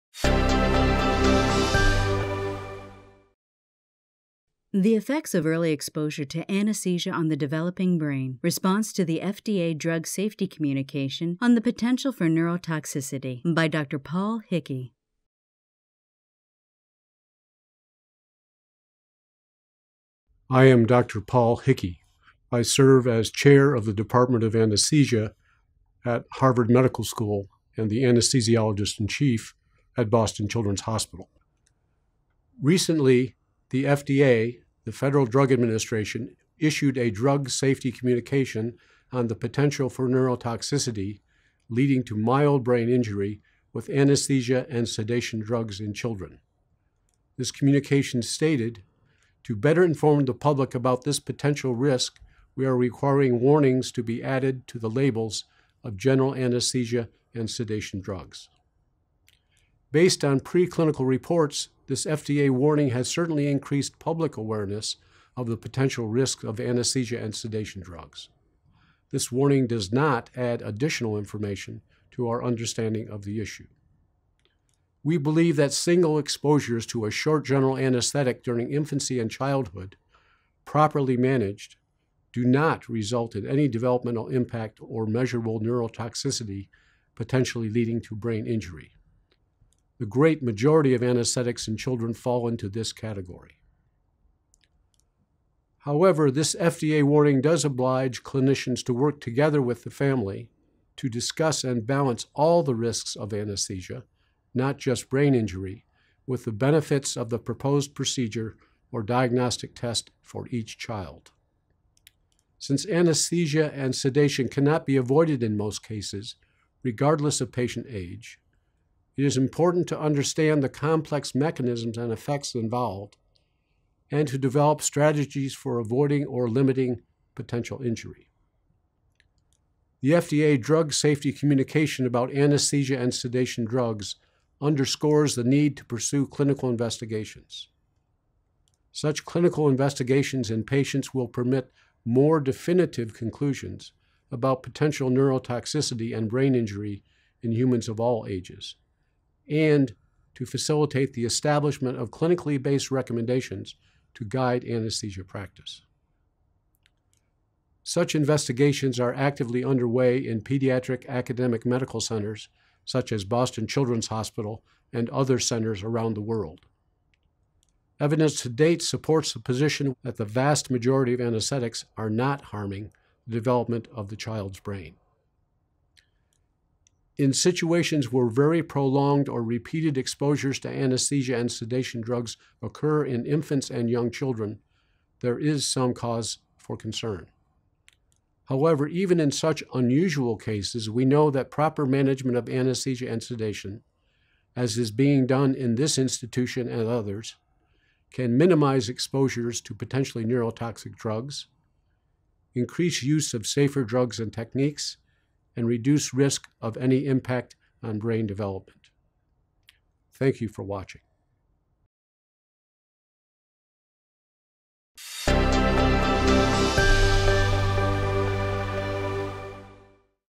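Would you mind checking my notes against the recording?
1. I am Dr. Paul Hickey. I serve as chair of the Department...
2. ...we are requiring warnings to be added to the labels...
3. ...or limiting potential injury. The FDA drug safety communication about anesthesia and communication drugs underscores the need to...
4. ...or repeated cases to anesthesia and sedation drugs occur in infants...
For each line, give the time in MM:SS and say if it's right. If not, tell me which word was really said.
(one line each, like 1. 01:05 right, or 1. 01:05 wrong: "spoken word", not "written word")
1. 00:20 right
2. 00:52 right
3. 02:06 wrong: "sedation", not "communication"
4. 02:59 wrong: "exposures", not "cases".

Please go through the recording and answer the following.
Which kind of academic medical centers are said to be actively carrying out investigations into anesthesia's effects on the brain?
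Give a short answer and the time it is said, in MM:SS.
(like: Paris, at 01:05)
Pediatric academic medical centers, at 02:40.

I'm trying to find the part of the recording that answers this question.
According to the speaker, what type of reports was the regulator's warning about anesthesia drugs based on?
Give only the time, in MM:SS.
01:00.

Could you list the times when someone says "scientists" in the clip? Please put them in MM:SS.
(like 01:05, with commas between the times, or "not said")
not said.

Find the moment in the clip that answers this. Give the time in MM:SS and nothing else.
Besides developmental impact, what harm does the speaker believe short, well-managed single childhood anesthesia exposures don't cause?
01:25.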